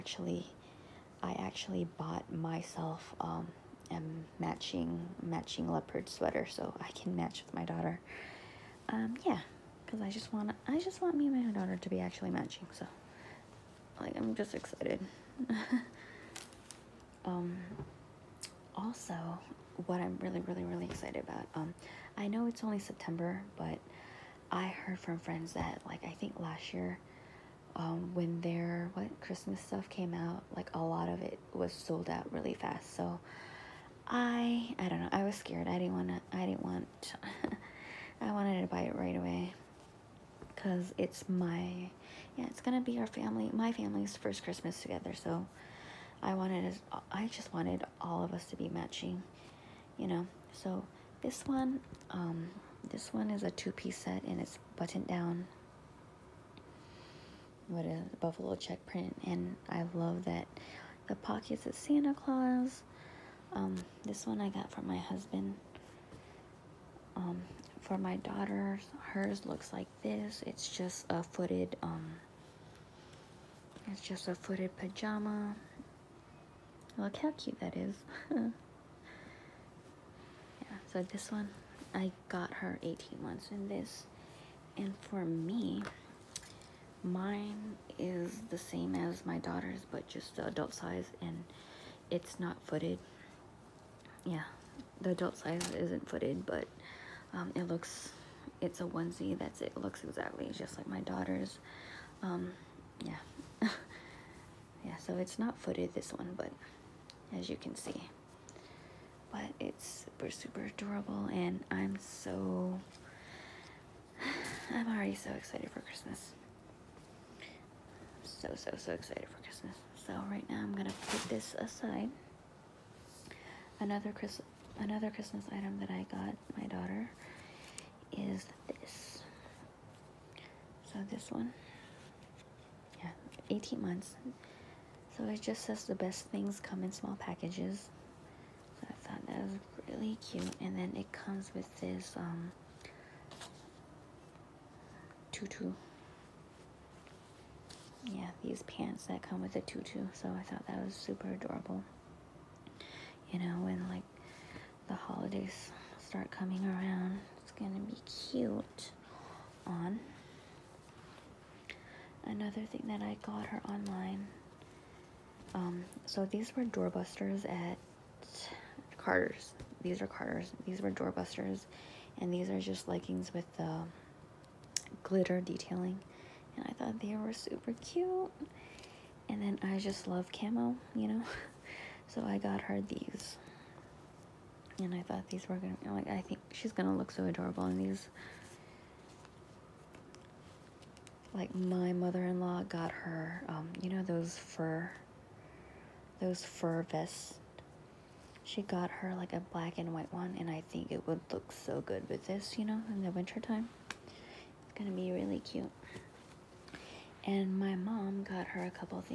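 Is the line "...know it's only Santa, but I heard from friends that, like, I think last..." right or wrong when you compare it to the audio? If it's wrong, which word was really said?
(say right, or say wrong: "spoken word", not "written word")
wrong: "September", not "Santa".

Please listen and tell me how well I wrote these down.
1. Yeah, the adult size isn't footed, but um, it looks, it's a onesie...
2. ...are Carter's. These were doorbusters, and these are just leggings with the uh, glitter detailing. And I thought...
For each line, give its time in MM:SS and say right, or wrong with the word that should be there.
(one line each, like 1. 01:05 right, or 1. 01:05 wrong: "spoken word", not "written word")
1. 01:34 right
2. 02:49 right.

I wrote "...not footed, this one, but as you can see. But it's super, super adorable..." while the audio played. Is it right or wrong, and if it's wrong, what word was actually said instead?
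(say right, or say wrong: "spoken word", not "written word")
right.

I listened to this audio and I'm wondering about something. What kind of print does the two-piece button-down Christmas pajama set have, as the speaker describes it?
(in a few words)
buffalo check.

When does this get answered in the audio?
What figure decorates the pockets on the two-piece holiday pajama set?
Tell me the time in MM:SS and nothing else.
01:01.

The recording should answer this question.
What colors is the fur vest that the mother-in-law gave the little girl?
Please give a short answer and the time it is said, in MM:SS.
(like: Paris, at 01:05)
black and white, at 03:19.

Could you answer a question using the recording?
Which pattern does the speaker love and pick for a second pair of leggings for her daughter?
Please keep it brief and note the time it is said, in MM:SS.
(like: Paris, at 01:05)
camo, at 03:00.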